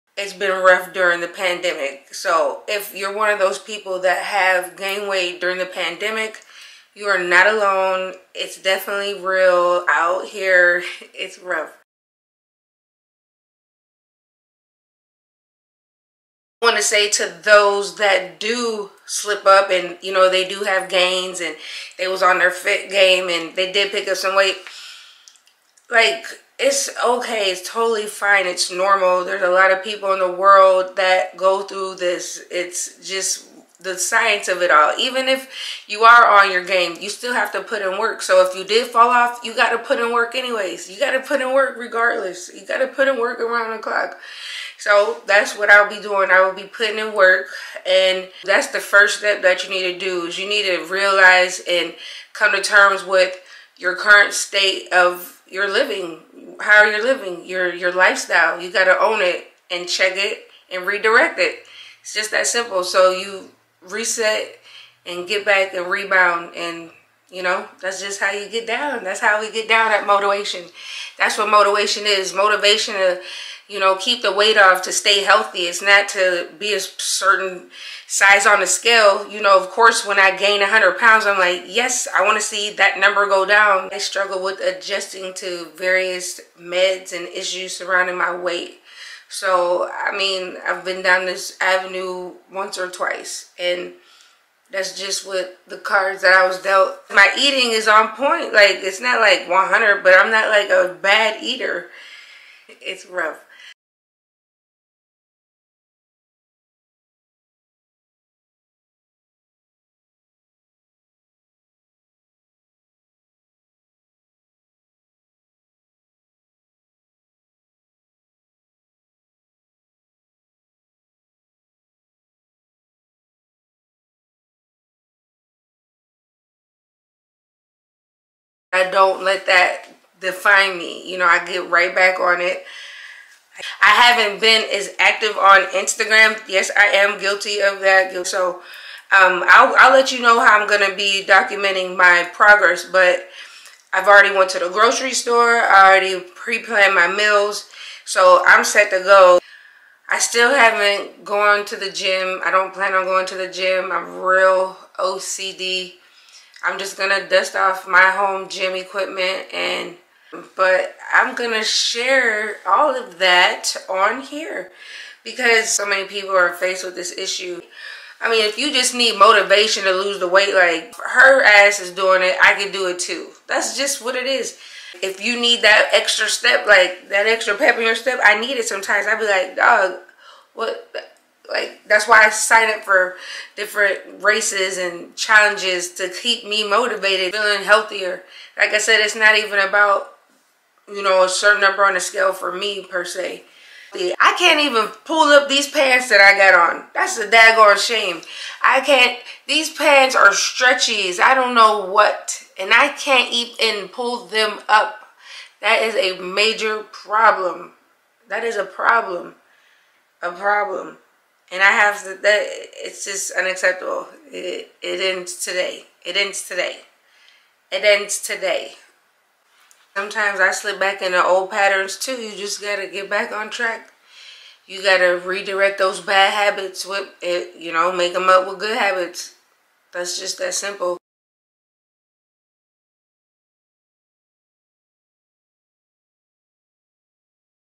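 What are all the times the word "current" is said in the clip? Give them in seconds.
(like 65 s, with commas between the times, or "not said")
53 s.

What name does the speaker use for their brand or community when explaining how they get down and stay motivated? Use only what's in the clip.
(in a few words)
MotiWEIGHTion.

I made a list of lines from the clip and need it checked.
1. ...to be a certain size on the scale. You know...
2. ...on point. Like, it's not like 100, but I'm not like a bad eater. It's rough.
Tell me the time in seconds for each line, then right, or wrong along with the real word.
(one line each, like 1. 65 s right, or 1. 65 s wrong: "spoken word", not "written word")
1. 76 s right
2. 97 s right.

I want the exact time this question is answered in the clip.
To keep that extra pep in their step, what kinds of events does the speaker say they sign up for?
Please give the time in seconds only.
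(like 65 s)
184 s.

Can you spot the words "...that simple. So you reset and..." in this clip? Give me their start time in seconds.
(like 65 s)
62 s.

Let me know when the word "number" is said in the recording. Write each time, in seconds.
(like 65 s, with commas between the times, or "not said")
82 s, 191 s.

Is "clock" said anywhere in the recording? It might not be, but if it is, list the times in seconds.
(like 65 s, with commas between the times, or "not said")
43 s.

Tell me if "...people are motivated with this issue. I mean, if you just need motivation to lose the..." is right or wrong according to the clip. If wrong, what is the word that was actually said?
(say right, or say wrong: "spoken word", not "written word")
wrong: "faced", not "motivated".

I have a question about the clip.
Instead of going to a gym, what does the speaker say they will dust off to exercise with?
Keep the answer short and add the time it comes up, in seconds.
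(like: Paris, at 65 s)
home gym equipment, at 158 s.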